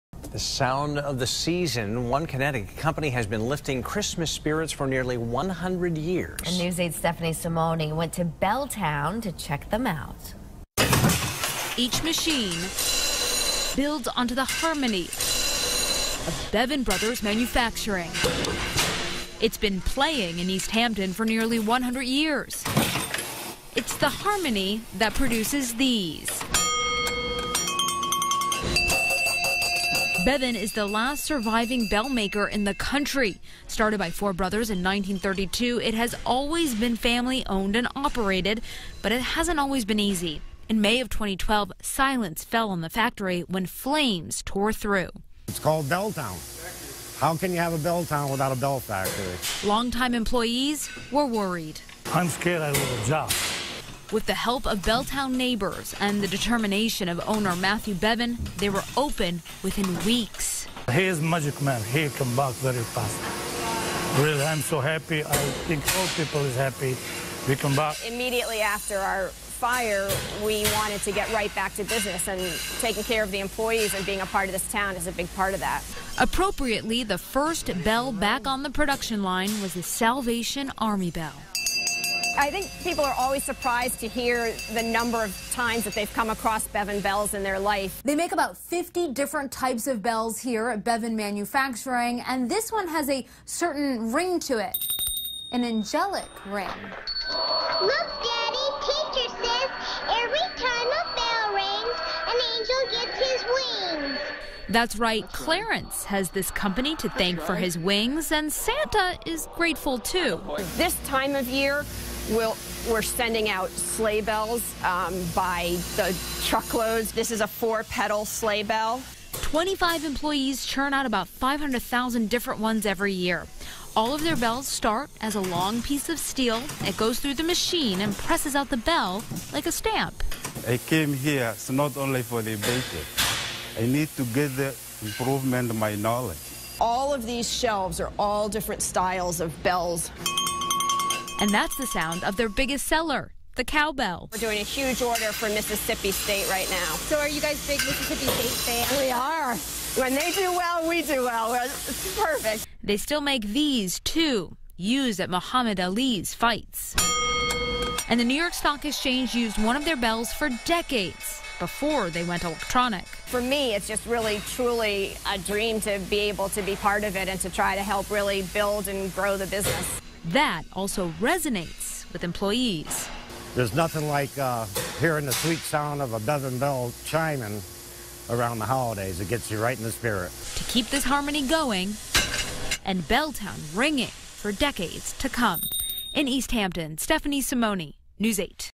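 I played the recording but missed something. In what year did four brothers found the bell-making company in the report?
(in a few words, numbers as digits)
1932.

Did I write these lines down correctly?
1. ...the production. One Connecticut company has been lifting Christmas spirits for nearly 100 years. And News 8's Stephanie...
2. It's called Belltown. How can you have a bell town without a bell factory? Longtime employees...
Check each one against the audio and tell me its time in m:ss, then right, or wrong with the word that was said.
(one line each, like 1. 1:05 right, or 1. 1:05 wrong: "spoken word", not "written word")
1. 0:01 wrong: "season", not "production"
2. 0:45 right.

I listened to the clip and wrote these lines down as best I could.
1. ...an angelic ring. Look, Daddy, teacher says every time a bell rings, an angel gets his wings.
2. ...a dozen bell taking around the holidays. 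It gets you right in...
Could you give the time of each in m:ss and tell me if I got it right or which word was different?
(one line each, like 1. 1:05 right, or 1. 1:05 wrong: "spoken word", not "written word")
1. 1:35 right
2. 2:56 wrong: "chiming", not "taking".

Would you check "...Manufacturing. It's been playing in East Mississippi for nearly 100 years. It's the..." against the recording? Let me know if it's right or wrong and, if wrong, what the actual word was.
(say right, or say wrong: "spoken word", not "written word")
wrong: "Hampton", not "Mississippi".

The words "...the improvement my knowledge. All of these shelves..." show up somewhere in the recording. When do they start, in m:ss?
2:14.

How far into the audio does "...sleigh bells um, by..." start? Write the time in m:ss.
1:53.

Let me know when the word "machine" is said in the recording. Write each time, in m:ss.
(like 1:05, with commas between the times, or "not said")
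0:12, 2:07.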